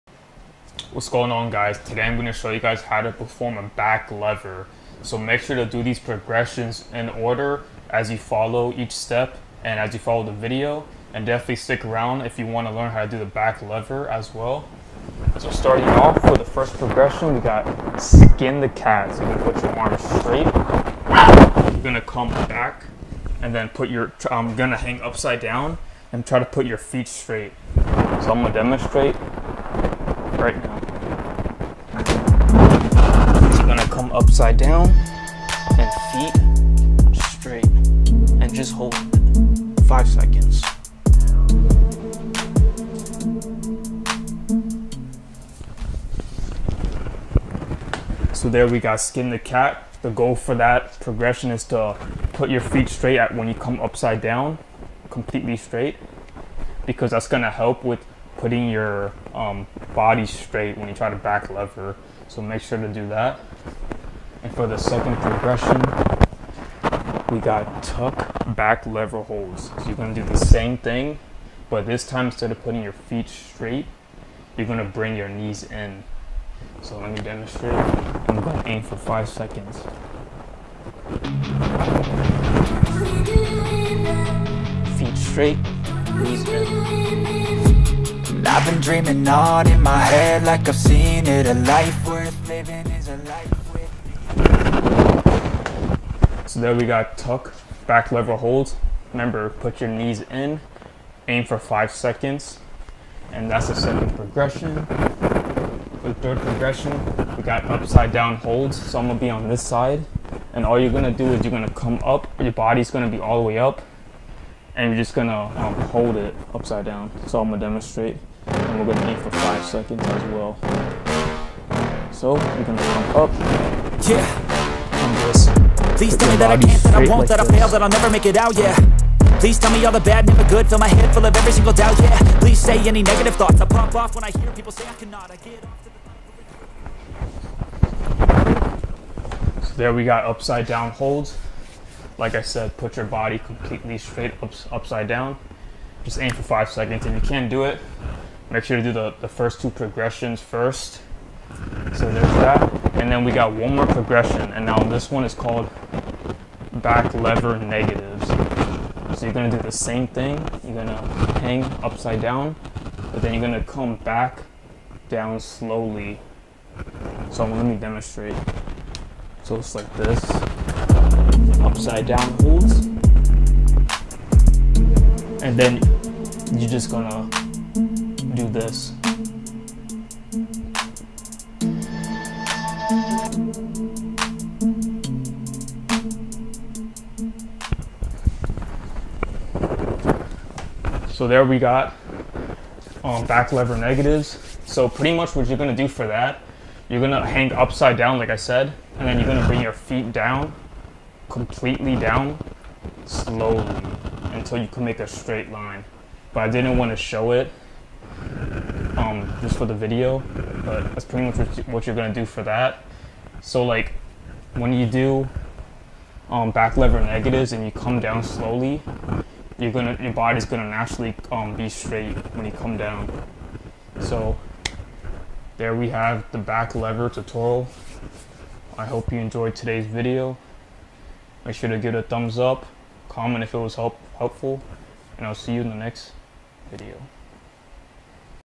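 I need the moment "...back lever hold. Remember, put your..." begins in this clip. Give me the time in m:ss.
1:37.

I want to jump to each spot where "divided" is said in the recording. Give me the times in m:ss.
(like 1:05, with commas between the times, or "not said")
not said.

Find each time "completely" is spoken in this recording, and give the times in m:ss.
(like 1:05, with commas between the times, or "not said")
0:55, 2:23, 3:21.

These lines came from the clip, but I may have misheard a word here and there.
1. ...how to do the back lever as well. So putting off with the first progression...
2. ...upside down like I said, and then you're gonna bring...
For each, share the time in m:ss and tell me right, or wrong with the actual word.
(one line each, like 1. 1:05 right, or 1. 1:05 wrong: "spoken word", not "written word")
1. 0:12 wrong: "starting", not "putting"
2. 3:17 right.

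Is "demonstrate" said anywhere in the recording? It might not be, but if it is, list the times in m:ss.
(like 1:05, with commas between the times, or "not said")
0:28, 1:17, 1:57, 2:47.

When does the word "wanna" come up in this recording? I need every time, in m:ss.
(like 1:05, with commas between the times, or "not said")
3:26.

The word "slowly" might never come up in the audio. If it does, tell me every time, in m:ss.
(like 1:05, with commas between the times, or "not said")
2:45, 3:23, 3:38.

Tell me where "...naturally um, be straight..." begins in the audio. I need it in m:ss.
3:40.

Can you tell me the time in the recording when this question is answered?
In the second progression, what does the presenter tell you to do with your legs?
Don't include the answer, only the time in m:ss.
1:14.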